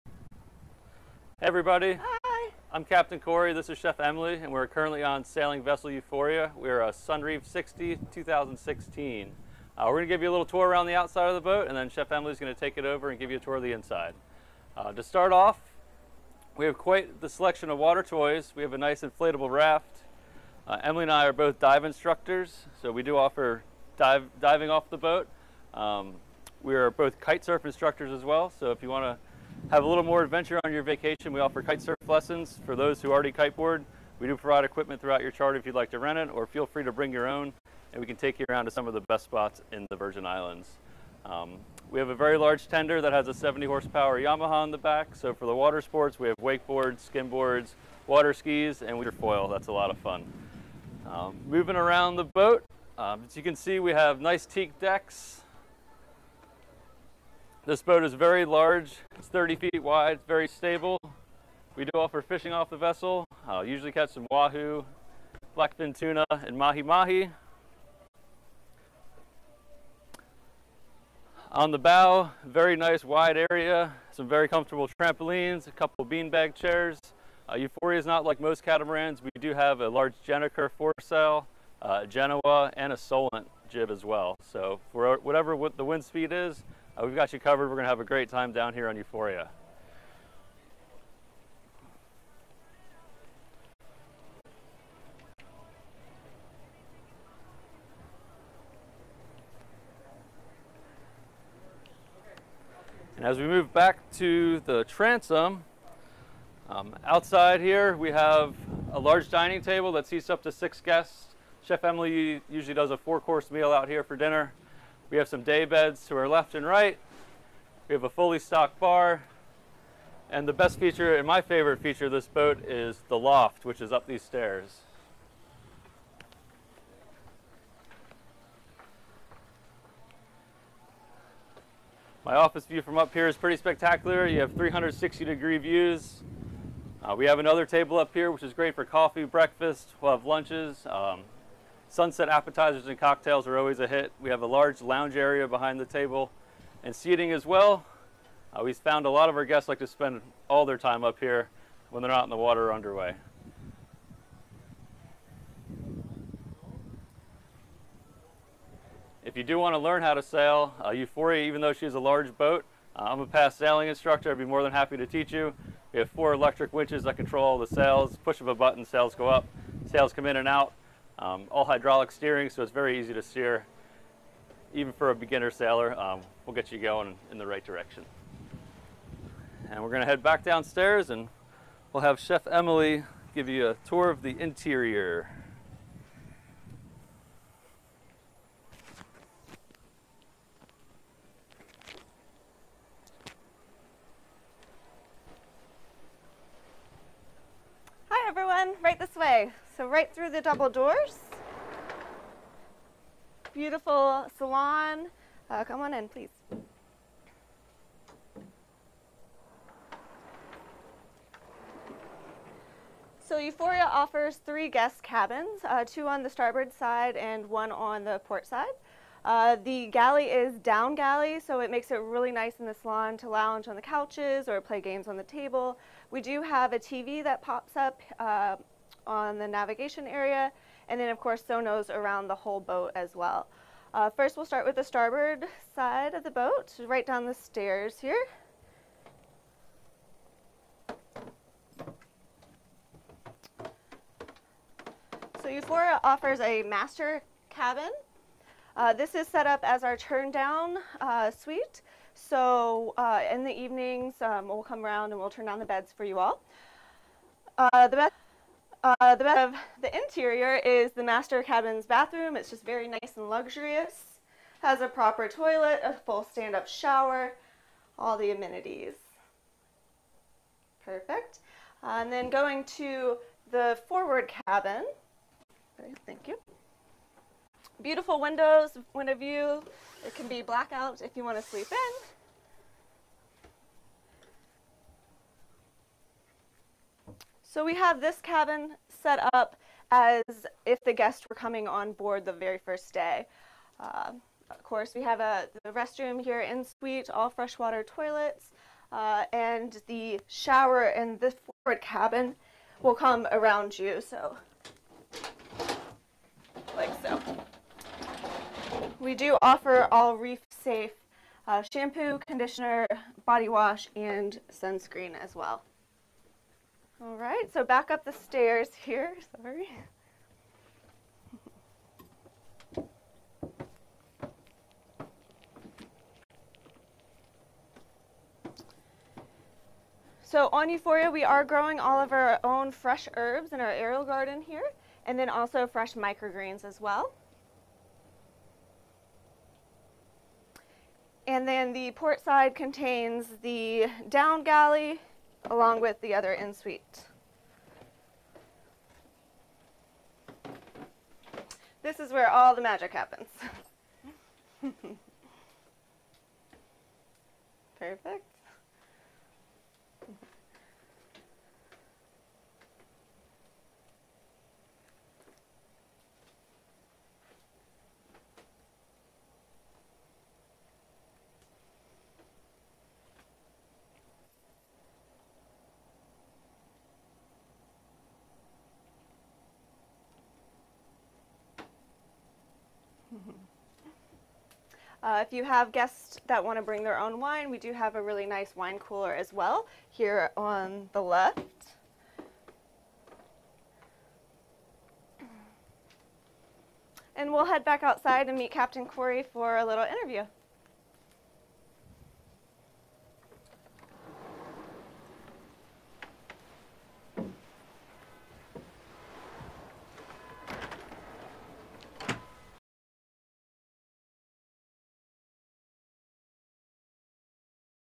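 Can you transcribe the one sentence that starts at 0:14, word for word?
Uh, to start off, we have quite the selection of water toys.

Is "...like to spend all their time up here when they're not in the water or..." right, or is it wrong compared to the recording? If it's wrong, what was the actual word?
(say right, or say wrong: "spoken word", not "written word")
right.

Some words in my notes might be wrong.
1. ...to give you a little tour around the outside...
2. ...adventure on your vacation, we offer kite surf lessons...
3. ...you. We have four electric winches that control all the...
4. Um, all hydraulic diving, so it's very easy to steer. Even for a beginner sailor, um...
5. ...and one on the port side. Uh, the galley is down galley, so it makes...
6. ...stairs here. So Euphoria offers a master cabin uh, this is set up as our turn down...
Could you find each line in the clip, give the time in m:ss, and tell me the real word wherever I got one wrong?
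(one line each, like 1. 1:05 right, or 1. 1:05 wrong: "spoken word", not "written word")
1. 0:10 right
2. 0:30 right
3. 2:45 right
4. 2:51 wrong: "steering", not "diving"
5. 3:37 right
6. 3:57 right.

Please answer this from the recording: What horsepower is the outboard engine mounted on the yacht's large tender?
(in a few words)
70.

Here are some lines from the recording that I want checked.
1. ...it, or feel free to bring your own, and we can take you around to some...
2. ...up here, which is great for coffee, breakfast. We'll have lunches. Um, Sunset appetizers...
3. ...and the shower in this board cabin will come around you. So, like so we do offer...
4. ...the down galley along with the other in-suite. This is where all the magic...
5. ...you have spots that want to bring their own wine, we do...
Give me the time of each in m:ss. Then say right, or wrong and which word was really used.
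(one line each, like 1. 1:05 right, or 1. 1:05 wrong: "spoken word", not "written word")
1. 0:36 right
2. 2:17 right
3. 4:59 wrong: "forward", not "board"
4. 5:43 right
5. 6:25 wrong: "guests", not "spots".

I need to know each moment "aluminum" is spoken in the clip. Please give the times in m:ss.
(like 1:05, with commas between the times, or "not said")
not said.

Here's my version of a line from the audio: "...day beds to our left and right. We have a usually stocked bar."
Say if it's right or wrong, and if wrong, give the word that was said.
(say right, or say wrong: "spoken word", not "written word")
wrong: "fully", not "usually".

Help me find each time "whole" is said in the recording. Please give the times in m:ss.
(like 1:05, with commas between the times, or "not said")
3:52.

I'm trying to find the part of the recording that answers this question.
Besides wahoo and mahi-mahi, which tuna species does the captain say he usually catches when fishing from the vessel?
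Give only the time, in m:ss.
1:05.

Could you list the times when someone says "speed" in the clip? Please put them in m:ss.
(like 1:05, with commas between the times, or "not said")
1:26.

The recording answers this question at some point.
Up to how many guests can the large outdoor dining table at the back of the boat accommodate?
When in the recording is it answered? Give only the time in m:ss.
1:50.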